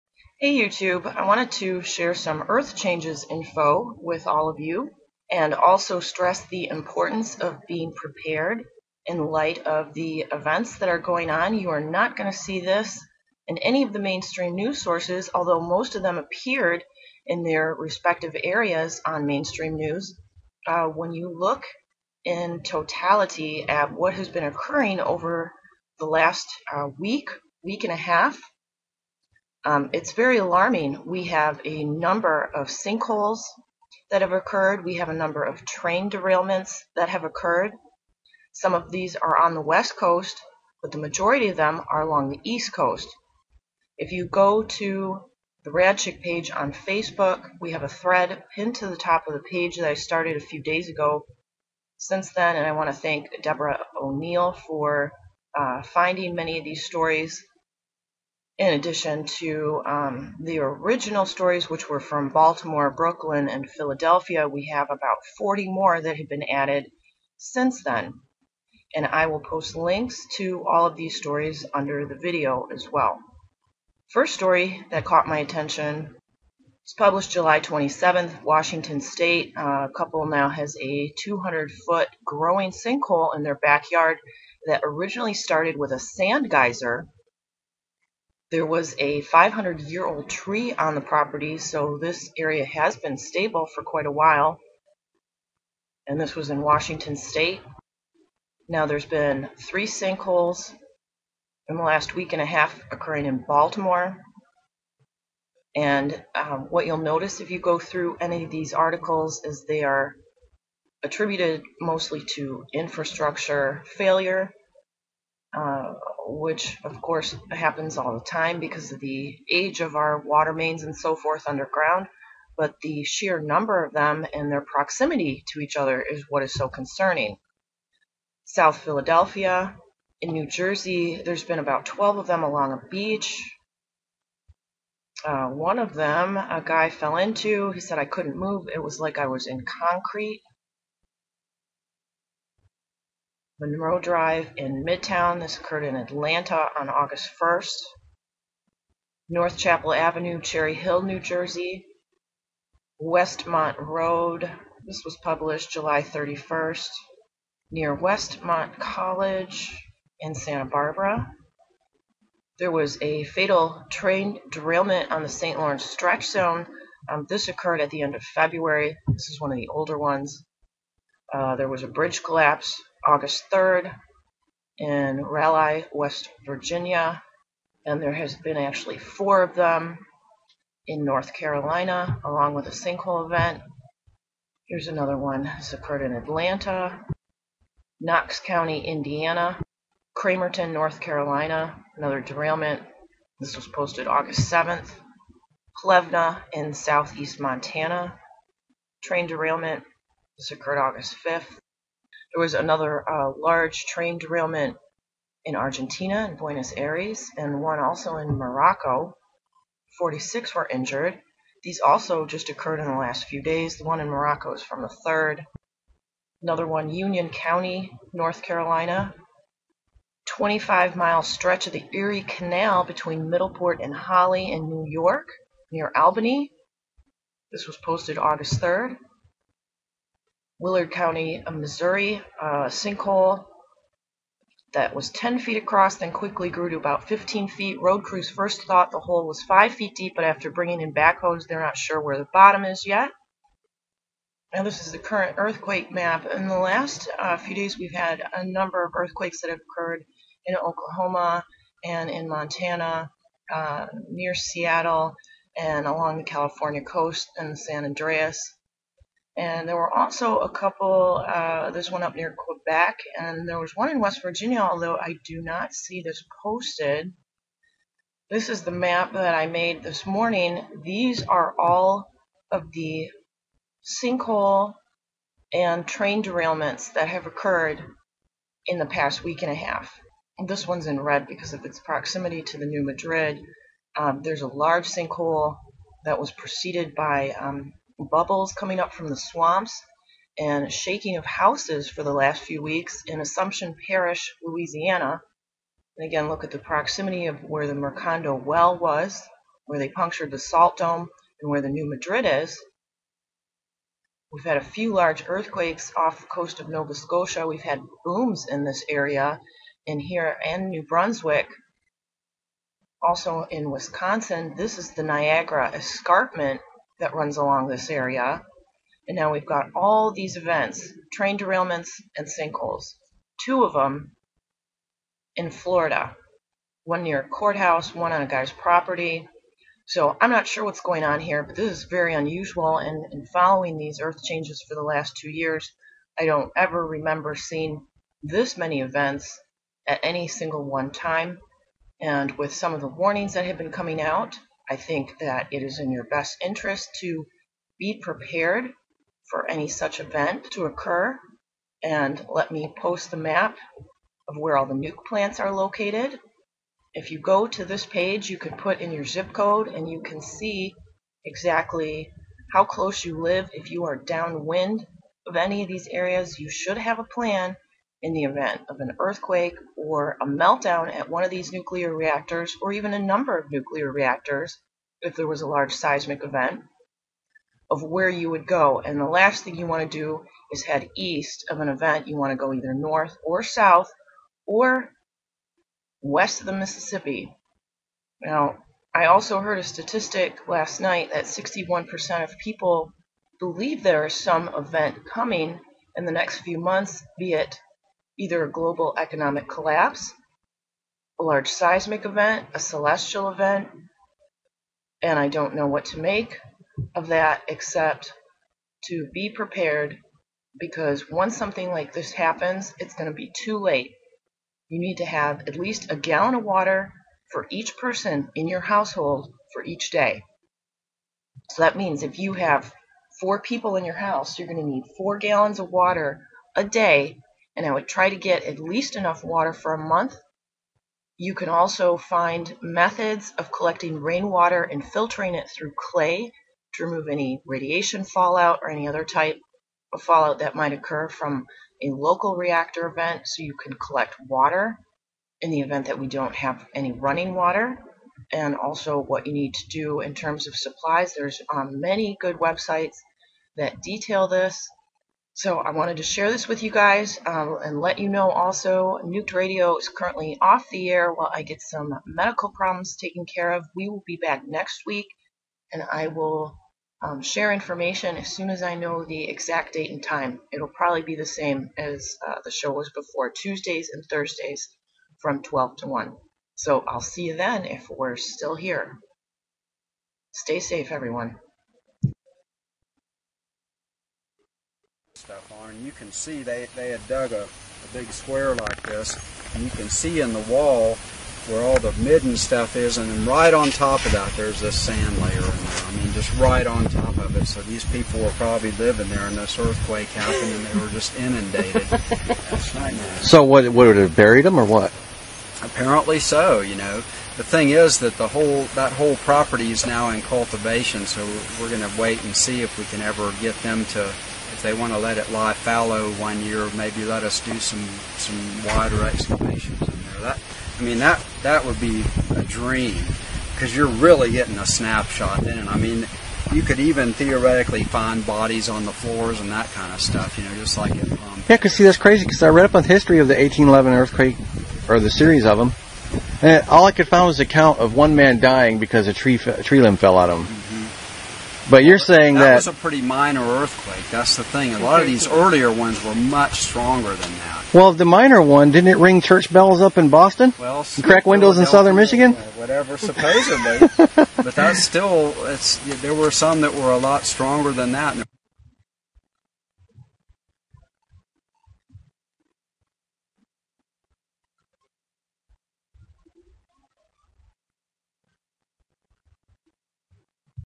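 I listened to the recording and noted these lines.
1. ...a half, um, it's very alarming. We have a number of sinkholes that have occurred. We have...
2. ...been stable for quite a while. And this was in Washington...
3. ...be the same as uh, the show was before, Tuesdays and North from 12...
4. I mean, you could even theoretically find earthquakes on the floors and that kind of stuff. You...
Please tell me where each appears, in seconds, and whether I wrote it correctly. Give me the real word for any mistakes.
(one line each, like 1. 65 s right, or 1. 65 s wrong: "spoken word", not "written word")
1. 27 s right
2. 92 s right
3. 471 s wrong: "Thursdays", not "North"
4. 525 s wrong: "bodies", not "earthquakes".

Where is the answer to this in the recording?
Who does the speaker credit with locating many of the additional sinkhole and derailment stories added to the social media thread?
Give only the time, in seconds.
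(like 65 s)
53 s.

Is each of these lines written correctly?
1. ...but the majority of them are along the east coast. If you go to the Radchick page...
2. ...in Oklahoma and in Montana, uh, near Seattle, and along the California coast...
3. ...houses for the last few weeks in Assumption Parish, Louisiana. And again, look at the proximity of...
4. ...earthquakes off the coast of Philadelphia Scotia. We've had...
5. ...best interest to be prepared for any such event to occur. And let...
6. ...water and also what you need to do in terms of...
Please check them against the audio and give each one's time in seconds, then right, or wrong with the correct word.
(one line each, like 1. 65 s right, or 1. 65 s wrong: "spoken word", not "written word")
1. 40 s right
2. 250 s right
3. 291 s right
4. 305 s wrong: "Nova", not "Philadelphia"
5. 346 s right
6. 447 s right.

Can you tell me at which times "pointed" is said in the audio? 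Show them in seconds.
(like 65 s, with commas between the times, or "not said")
not said.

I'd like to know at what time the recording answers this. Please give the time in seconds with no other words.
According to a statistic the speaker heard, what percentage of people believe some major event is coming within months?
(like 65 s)
391 s.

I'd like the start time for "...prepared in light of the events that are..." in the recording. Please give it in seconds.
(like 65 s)
7 s.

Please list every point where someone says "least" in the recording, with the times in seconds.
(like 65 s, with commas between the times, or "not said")
415 s, 428 s.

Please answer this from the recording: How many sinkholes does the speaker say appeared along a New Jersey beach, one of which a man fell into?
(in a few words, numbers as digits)
About 12.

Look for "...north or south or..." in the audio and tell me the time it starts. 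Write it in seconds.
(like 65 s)
382 s.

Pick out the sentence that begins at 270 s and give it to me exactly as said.
These are all of the sinkhole and train derailments that have occurred in the past week and a half.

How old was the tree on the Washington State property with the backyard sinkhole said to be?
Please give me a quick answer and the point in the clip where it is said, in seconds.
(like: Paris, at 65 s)
500 years, at 89 s.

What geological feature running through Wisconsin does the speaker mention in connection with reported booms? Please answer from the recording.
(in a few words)
Niagara Escarpment.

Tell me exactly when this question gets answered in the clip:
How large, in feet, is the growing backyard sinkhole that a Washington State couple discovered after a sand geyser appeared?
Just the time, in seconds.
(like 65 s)
81 s.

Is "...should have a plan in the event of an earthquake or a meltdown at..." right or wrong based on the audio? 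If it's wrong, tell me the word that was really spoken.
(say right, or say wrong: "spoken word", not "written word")
right.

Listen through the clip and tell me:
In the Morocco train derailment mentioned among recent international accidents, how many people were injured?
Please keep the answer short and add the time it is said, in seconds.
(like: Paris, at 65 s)
46, at 209 s.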